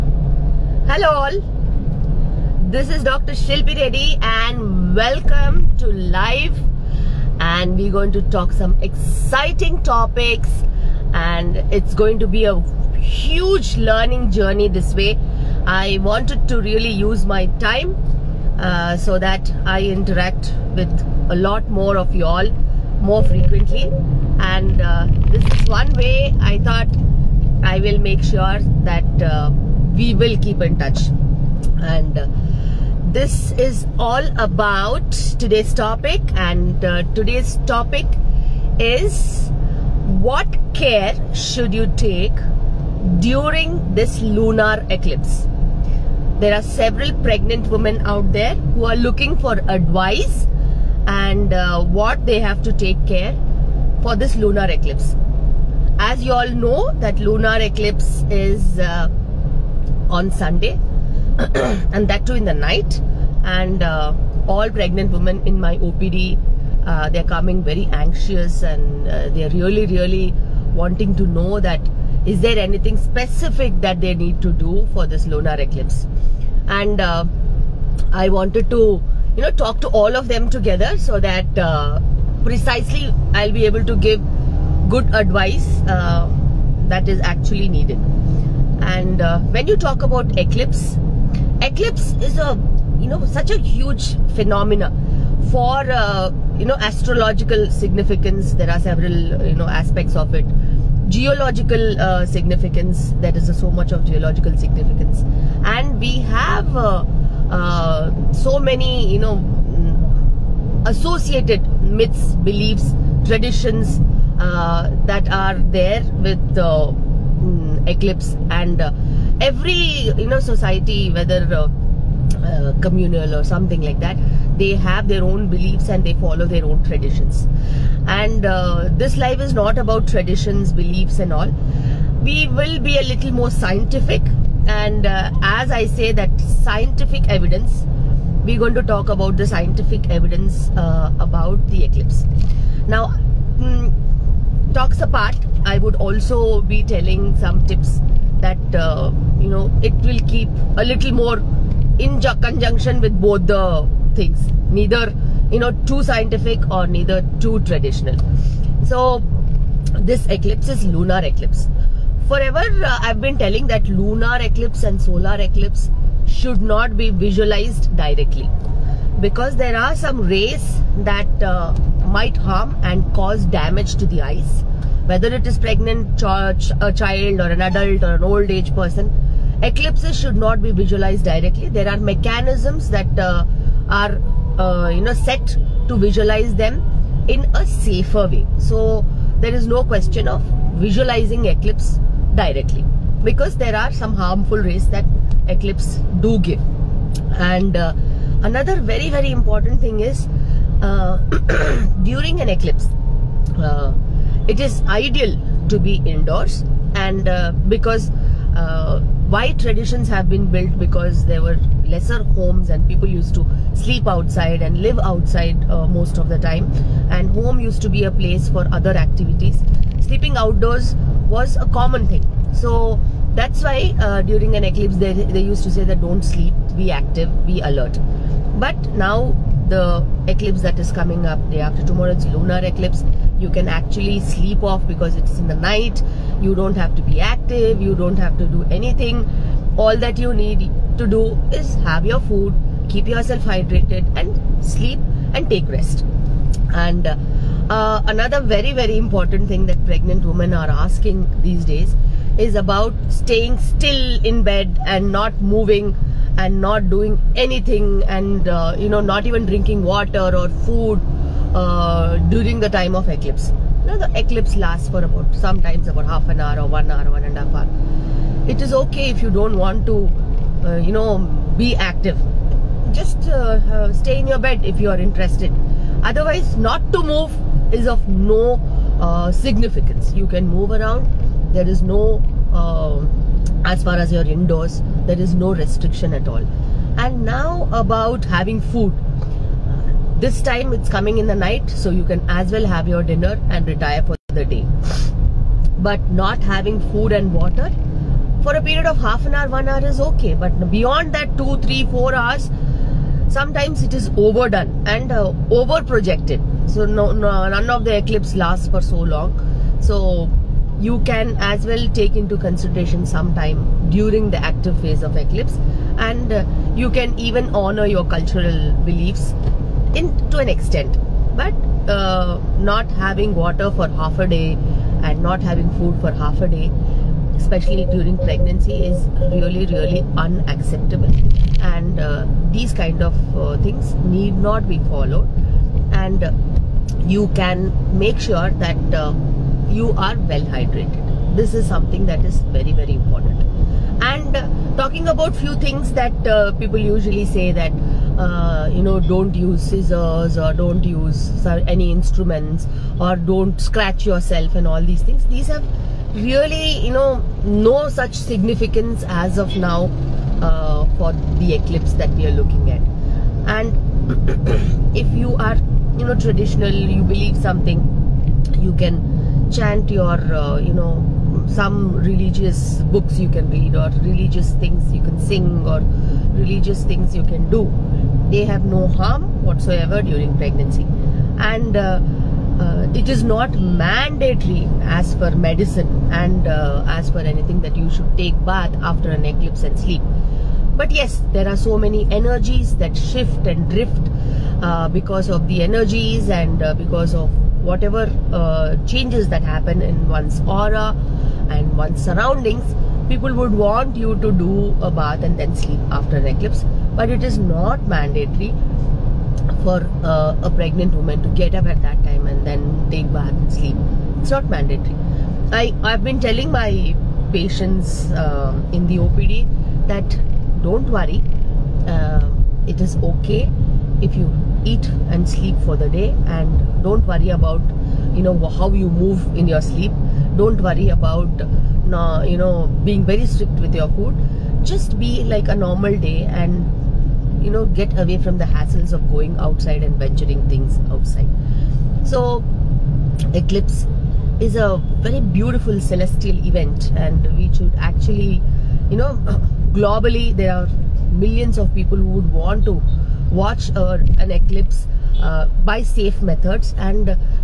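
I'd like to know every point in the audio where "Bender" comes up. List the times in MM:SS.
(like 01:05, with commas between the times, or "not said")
not said.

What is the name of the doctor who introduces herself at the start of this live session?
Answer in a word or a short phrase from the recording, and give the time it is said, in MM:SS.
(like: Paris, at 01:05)
Dr. Shilpi Reddy, at 00:03.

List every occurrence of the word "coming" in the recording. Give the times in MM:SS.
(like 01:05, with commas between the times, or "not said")
01:07, 03:50, 04:50.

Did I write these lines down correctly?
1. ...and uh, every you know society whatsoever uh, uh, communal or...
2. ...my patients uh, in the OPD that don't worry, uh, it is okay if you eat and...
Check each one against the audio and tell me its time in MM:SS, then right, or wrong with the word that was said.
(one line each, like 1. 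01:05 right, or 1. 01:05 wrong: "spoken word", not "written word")
1. 01:58 wrong: "whether", not "whatsoever"
2. 06:56 right.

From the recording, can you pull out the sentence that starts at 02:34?
Neither, you know, too scientific or neither too traditional.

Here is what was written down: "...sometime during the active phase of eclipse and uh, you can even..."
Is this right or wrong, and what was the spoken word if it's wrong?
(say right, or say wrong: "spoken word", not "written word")
right.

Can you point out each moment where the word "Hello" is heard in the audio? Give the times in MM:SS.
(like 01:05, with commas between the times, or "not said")
00:00.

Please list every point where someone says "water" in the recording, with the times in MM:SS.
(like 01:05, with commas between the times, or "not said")
04:19, 04:57, 05:23.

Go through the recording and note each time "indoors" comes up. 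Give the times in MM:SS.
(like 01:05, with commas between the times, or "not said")
03:26, 04:44.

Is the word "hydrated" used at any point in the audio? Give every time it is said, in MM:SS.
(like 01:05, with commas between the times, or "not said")
04:03, 05:40.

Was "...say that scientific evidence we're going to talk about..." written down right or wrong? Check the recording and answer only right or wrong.
right.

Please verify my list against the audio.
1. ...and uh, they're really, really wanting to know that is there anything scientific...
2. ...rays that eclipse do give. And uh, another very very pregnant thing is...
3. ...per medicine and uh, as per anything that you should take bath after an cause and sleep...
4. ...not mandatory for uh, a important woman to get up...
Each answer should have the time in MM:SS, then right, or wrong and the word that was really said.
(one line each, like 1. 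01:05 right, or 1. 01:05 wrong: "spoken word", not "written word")
1. 01:08 wrong: "specific", not "scientific"
2. 03:14 wrong: "important", not "pregnant"
3. 06:25 wrong: "eclipse", not "cause"
4. 06:47 wrong: "pregnant", not "important".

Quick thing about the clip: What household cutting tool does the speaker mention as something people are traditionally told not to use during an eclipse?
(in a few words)
Scissors.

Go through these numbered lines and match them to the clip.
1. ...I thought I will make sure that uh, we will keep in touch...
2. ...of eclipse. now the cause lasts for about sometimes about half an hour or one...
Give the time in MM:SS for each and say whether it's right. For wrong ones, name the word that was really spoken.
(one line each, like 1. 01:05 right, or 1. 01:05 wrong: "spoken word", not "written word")
1. 00:26 right
2. 04:22 wrong: "eclipse", not "cause".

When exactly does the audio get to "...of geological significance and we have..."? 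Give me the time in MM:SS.
01:43.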